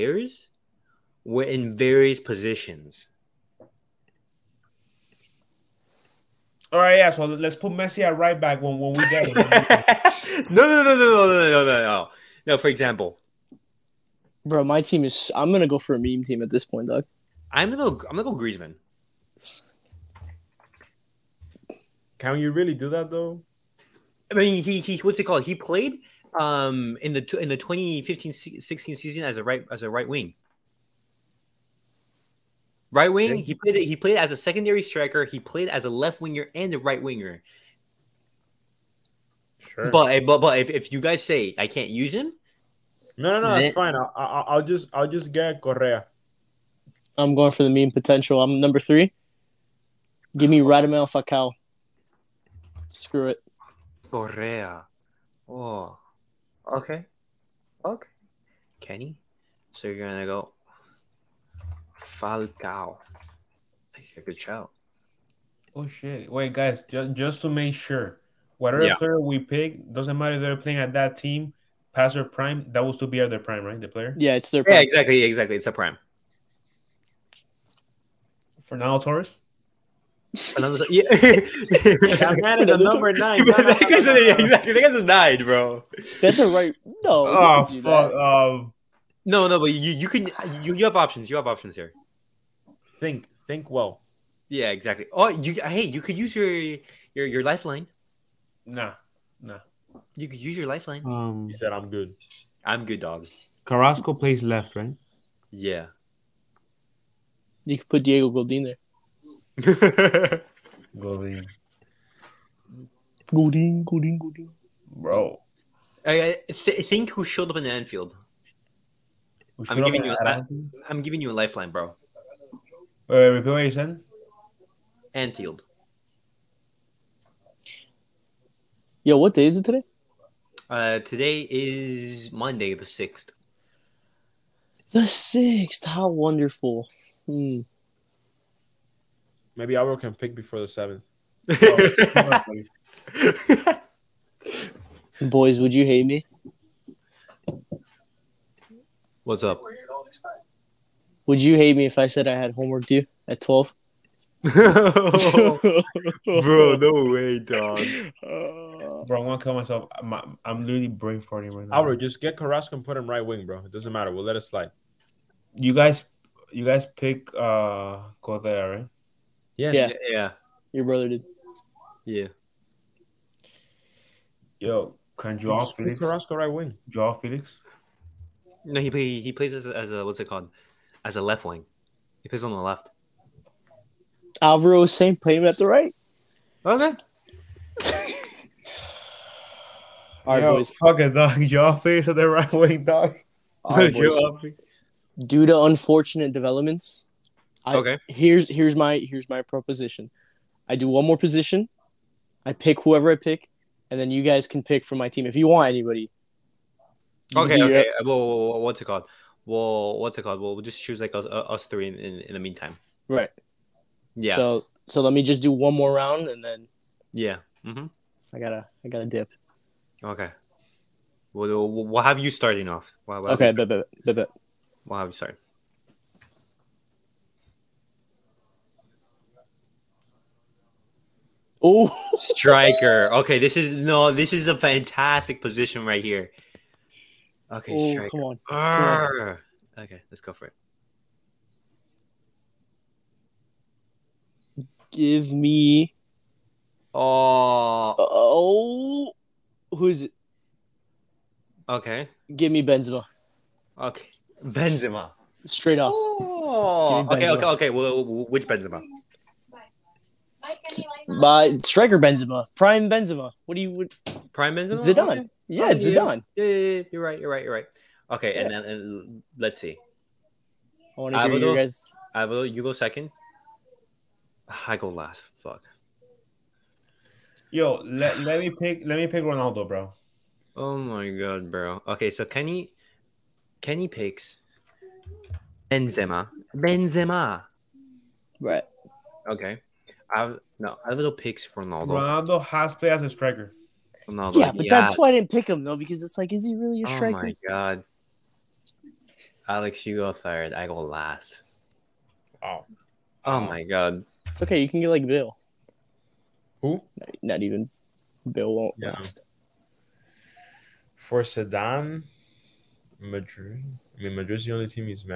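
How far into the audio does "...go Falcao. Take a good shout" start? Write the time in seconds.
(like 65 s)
60 s.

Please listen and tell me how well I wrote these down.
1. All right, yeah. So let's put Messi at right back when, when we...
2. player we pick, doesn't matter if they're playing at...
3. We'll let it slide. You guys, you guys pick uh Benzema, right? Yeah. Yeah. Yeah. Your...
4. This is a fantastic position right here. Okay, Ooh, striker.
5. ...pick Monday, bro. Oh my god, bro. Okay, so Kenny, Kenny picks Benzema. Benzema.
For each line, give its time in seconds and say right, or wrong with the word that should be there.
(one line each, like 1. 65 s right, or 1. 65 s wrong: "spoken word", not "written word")
1. 6 s right
2. 68 s right
3. 164 s wrong: "Correa", not "Benzema"
4. 234 s right
5. 279 s wrong: "Ronaldo", not "Monday".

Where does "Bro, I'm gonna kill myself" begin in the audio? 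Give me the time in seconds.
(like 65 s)
159 s.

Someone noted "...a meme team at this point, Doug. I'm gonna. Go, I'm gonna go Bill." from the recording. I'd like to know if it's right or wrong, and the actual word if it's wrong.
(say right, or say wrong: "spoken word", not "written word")
wrong: "Griezmann", not "Bill".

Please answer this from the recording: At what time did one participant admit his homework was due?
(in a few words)
12.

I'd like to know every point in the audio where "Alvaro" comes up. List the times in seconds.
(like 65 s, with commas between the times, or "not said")
184 s, 290 s.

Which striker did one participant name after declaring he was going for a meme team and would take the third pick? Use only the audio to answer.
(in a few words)
Radamel Falcao.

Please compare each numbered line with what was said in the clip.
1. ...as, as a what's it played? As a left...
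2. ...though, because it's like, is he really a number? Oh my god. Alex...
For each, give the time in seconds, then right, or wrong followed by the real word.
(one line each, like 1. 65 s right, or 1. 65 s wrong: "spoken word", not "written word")
1. 179 s wrong: "called", not "played"
2. 295 s wrong: "striker", not "number".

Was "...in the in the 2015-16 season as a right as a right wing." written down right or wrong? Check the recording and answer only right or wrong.
right.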